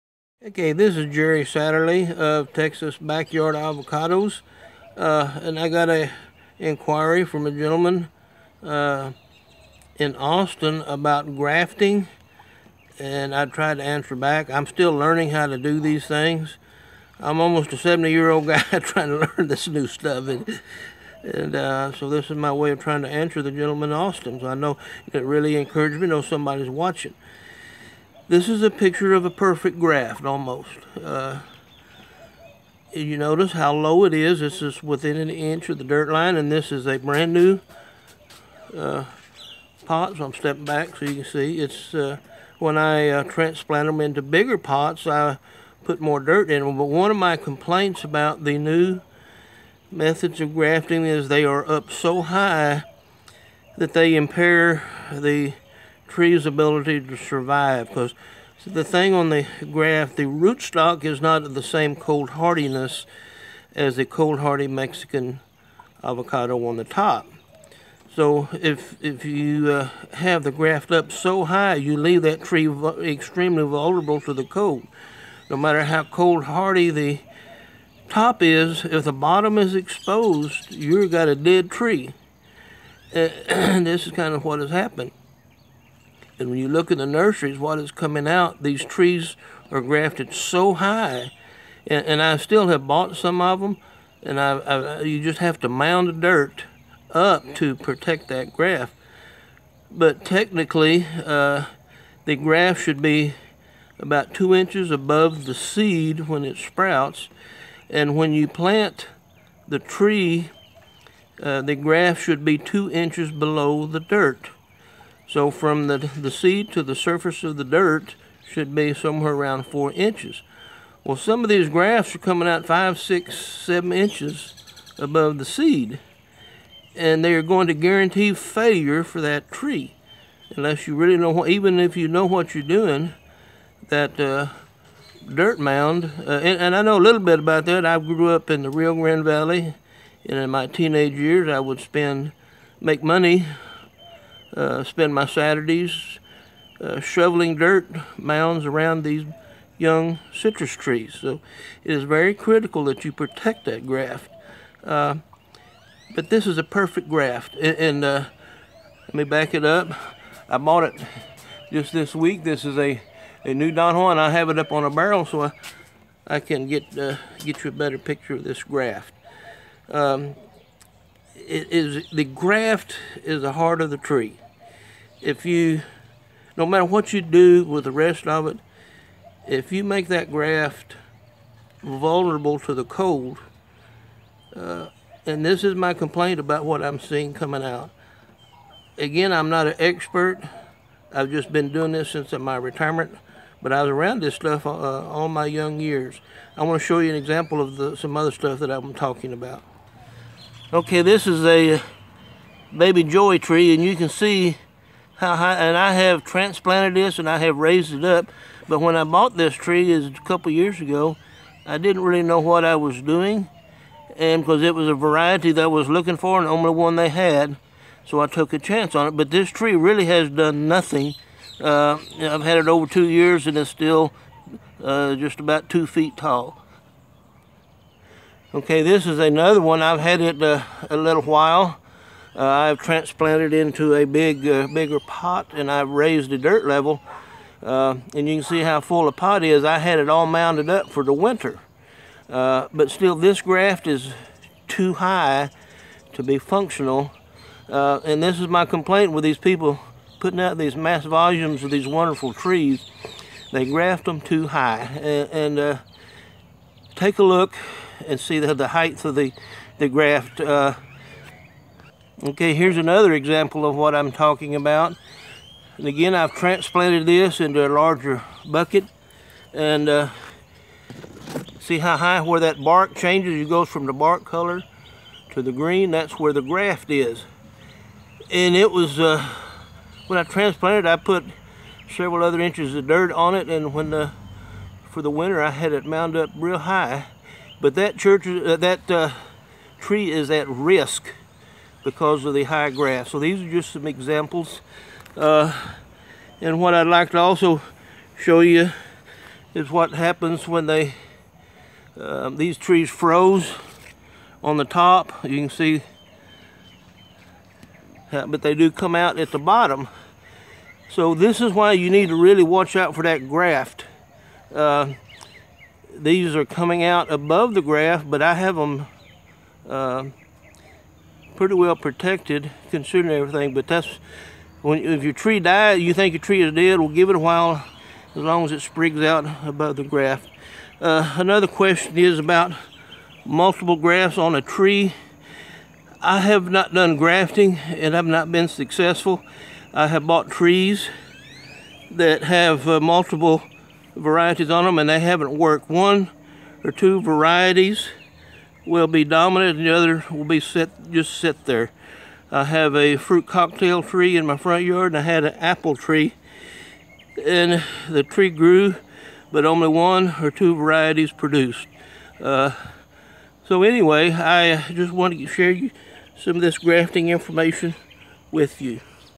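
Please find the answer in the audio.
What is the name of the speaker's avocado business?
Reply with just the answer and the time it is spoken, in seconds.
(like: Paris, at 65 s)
Texas Backyard Avocados, at 2 s.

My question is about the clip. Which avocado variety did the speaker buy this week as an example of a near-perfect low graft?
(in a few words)
Don Juan.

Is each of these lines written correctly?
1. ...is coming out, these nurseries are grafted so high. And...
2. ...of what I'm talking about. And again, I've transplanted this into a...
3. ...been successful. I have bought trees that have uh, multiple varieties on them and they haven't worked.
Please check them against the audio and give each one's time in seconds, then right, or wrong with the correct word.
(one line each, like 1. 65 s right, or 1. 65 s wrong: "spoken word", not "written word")
1. 87 s wrong: "trees", not "nurseries"
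2. 263 s right
3. 338 s right.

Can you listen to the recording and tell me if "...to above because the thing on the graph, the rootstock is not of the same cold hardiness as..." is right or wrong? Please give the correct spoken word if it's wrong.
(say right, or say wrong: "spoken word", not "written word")
wrong: "survive", not "above".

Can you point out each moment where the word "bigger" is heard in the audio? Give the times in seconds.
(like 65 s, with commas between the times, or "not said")
44 s, 234 s.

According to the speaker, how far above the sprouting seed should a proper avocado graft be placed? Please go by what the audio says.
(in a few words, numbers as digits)
2 inches.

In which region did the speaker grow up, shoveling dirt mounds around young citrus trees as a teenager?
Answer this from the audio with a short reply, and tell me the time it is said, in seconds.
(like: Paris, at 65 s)
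Rio Grande Valley, at 138 s.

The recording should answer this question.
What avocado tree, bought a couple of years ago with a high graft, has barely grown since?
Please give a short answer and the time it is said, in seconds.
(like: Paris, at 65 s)
Baby joy, at 202 s.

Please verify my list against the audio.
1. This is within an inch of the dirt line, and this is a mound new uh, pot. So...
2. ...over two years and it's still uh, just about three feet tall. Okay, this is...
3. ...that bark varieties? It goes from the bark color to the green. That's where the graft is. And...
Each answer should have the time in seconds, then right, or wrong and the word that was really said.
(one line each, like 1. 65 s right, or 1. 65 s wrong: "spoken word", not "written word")
1. 34 s wrong: "brand", not "mound"
2. 222 s wrong: "two", not "three"
3. 272 s wrong: "changes", not "varieties".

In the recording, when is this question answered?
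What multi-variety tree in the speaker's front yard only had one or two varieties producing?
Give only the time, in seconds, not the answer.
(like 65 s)
352 s.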